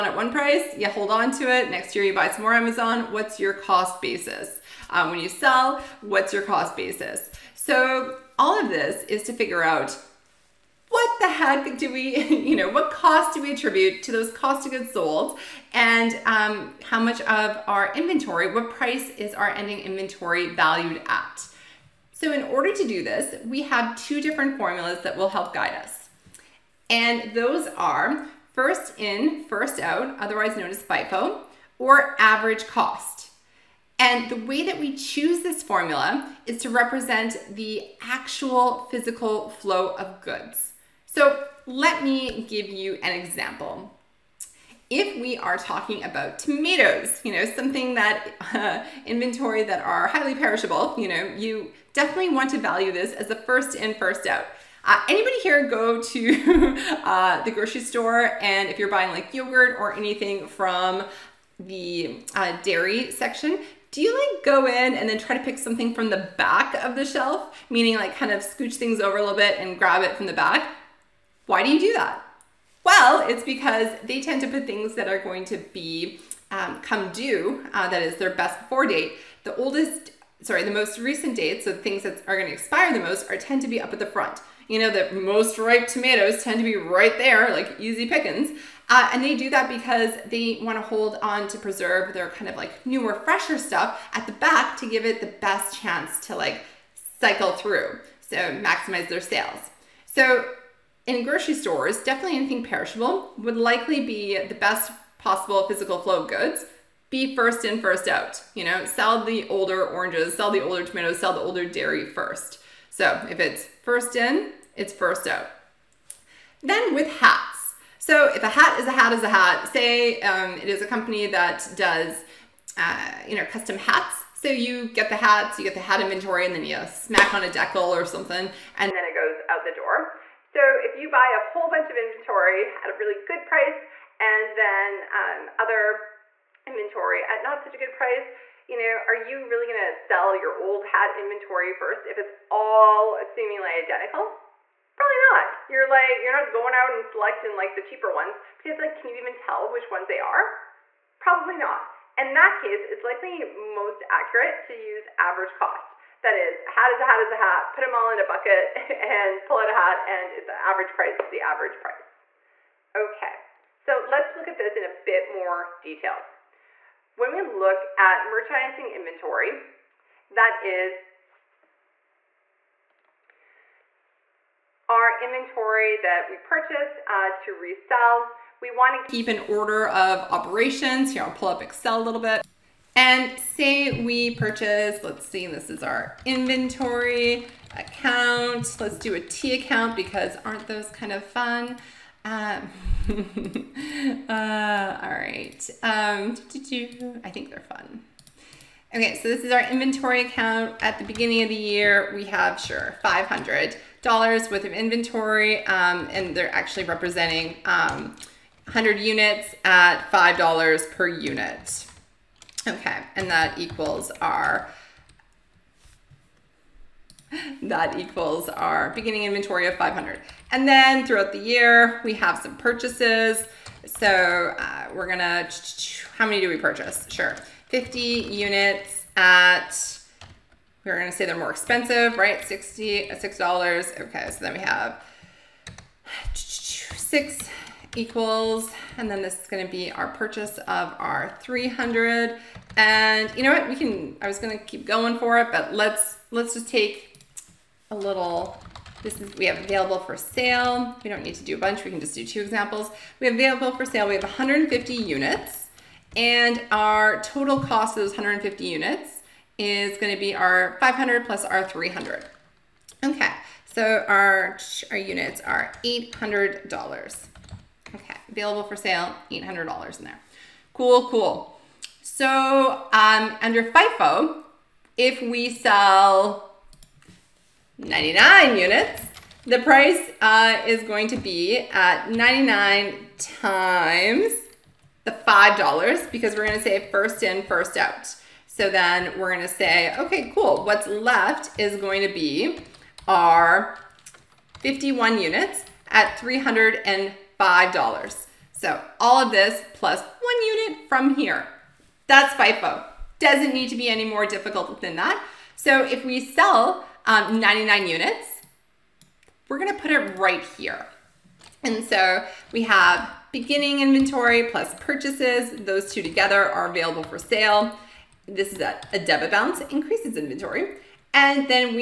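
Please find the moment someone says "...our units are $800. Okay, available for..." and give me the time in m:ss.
4:24.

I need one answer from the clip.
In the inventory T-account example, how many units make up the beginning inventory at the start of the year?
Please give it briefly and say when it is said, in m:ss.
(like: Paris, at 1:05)
100, at 3:27.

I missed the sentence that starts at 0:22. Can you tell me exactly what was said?
So in order to do this, we have two different formulas that will help guide us.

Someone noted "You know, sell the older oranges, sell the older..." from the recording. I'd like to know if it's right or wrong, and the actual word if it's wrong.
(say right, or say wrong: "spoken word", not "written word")
right.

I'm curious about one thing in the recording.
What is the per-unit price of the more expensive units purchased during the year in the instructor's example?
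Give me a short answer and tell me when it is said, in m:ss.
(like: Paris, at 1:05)
$6, at 3:53.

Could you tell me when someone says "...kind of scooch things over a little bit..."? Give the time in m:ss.
1:08.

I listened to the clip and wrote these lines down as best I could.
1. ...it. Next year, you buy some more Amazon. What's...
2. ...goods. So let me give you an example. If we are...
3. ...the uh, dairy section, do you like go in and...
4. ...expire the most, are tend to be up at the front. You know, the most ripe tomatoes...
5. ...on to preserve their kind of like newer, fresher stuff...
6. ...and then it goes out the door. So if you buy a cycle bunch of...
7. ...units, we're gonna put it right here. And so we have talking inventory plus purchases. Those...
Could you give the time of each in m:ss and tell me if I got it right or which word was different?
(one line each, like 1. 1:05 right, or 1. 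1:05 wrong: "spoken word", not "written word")
1. 0:01 right
2. 0:40 right
3. 1:01 right
4. 1:22 right
5. 1:31 right
6. 2:08 wrong: "whole", not "cycle"
7. 5:07 wrong: "beginning", not "talking".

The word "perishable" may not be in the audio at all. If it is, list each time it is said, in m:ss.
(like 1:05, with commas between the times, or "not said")
0:50, 1:42.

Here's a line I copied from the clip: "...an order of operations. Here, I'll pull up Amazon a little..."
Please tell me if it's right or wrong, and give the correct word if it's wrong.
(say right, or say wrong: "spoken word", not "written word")
wrong: "Excel", not "Amazon".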